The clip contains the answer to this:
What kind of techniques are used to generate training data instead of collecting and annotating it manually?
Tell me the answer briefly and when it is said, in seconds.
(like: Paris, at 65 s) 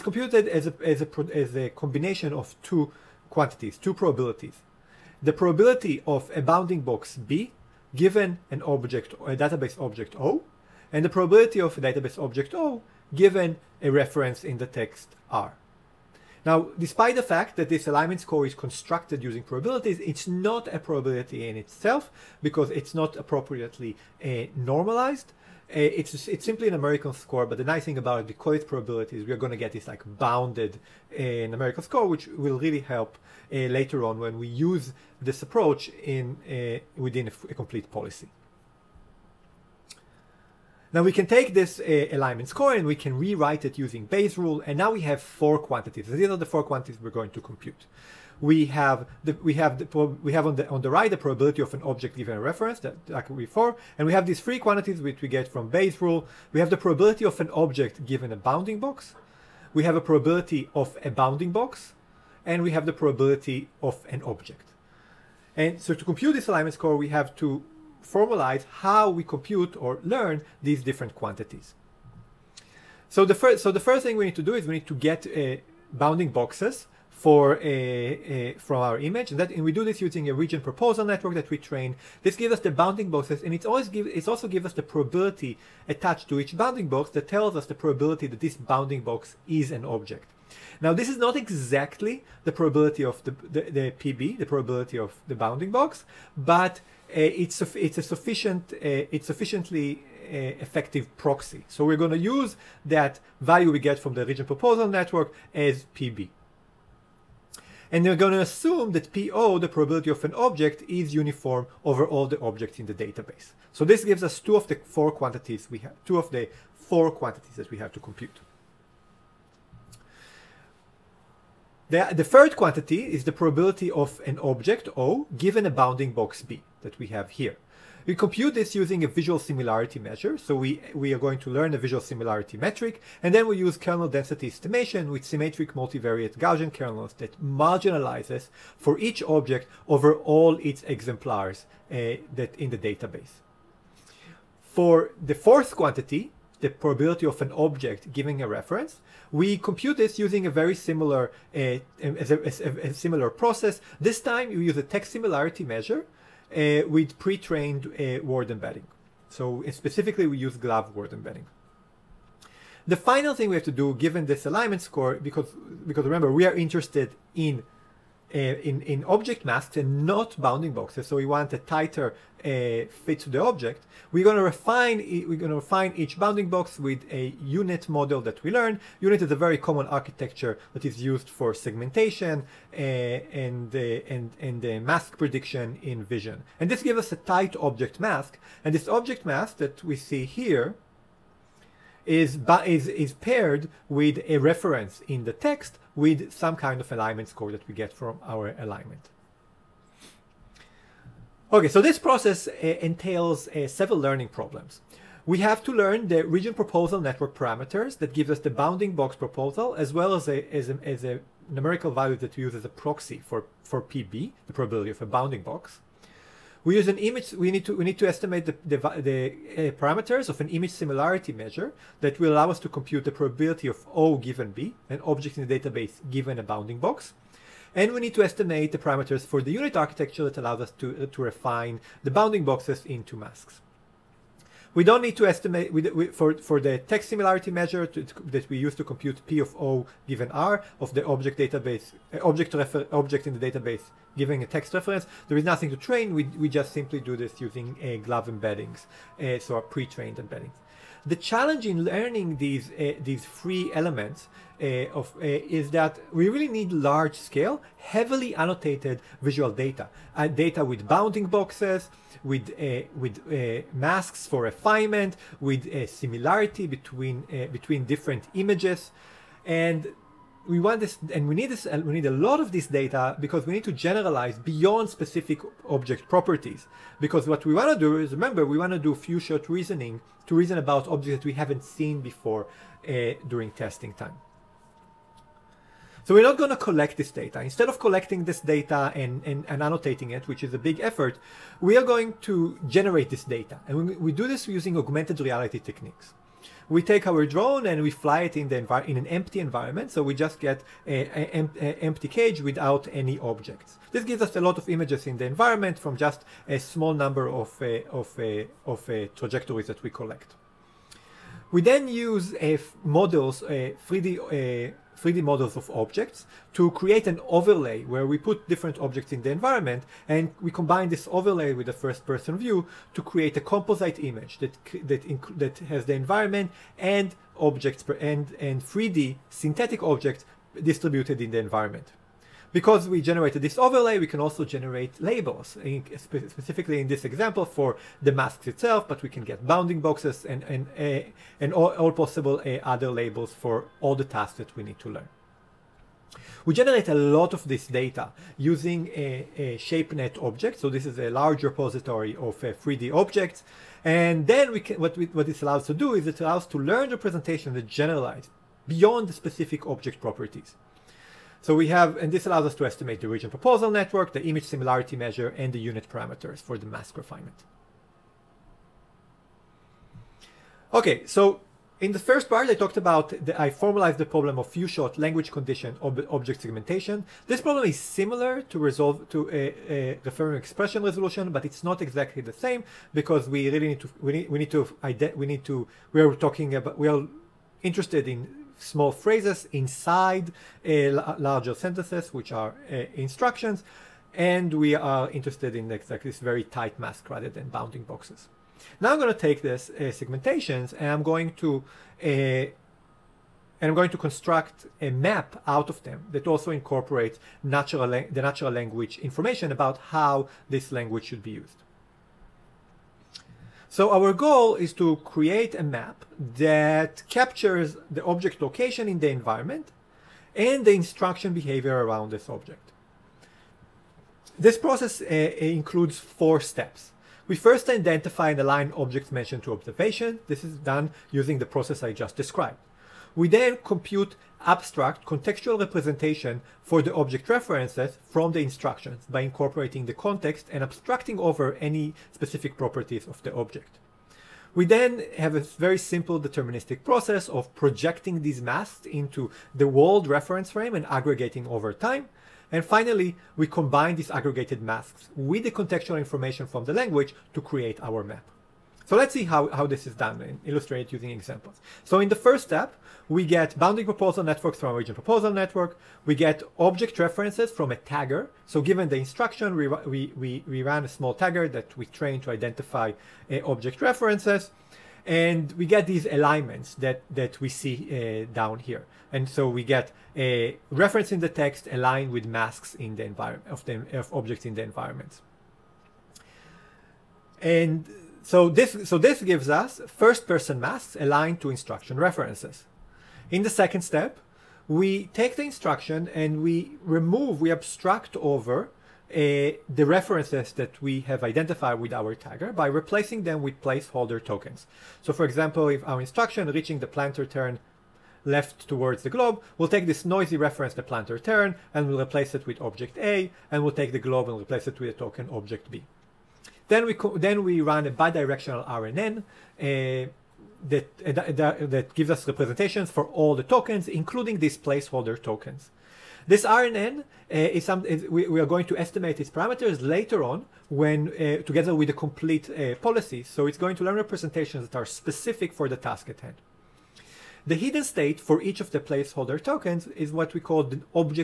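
Augmented reality, at 294 s.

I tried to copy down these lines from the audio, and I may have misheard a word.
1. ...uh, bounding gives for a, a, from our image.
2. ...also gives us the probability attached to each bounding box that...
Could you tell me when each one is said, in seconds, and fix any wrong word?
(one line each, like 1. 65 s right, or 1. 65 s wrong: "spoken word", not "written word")
1. 75 s wrong: "boxes", not "gives"
2. 84 s right.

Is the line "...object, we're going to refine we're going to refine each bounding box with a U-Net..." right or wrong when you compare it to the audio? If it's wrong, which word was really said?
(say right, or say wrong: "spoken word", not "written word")
right.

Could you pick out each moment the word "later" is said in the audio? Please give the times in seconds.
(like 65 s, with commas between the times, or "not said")
33 s, 529 s.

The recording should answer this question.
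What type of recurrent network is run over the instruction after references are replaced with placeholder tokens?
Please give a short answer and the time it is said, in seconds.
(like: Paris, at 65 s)
Bidirectional RNN, at 517 s.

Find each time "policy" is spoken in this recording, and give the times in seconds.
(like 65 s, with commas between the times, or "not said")
37 s, 532 s.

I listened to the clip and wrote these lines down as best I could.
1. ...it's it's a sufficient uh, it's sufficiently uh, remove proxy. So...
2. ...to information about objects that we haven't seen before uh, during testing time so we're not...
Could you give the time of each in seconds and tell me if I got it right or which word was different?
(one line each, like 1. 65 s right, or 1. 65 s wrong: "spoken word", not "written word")
1. 97 s wrong: "effective", not "remove"
2. 280 s wrong: "reason", not "information".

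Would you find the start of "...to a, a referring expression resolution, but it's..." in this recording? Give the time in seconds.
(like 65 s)
379 s.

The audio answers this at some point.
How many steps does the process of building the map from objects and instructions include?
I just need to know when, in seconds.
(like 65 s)
425 s.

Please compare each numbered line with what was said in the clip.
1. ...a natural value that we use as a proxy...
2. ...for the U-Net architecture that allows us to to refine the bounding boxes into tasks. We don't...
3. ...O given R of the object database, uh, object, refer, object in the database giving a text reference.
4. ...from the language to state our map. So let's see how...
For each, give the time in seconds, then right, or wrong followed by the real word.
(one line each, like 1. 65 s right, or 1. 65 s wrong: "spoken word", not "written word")
1. 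211 s wrong: "numerical", not "natural"
2. 229 s wrong: "masks", not "tasks"
3. 239 s right
4. 456 s wrong: "create", not "state".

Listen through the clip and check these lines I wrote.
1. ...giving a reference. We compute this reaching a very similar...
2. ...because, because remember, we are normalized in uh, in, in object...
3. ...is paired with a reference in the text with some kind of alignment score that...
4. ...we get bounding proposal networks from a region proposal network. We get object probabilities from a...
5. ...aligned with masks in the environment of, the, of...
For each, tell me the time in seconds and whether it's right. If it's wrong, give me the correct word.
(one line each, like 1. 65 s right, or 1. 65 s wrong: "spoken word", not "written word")
1. 148 s wrong: "using", not "reaching"
2. 165 s wrong: "interested", not "normalized"
3. 192 s right
4. 463 s wrong: "references", not "probabilities"
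5. 481 s right.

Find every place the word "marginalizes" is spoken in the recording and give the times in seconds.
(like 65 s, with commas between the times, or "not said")
137 s.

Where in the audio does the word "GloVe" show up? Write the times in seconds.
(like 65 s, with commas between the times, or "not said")
160 s, 248 s.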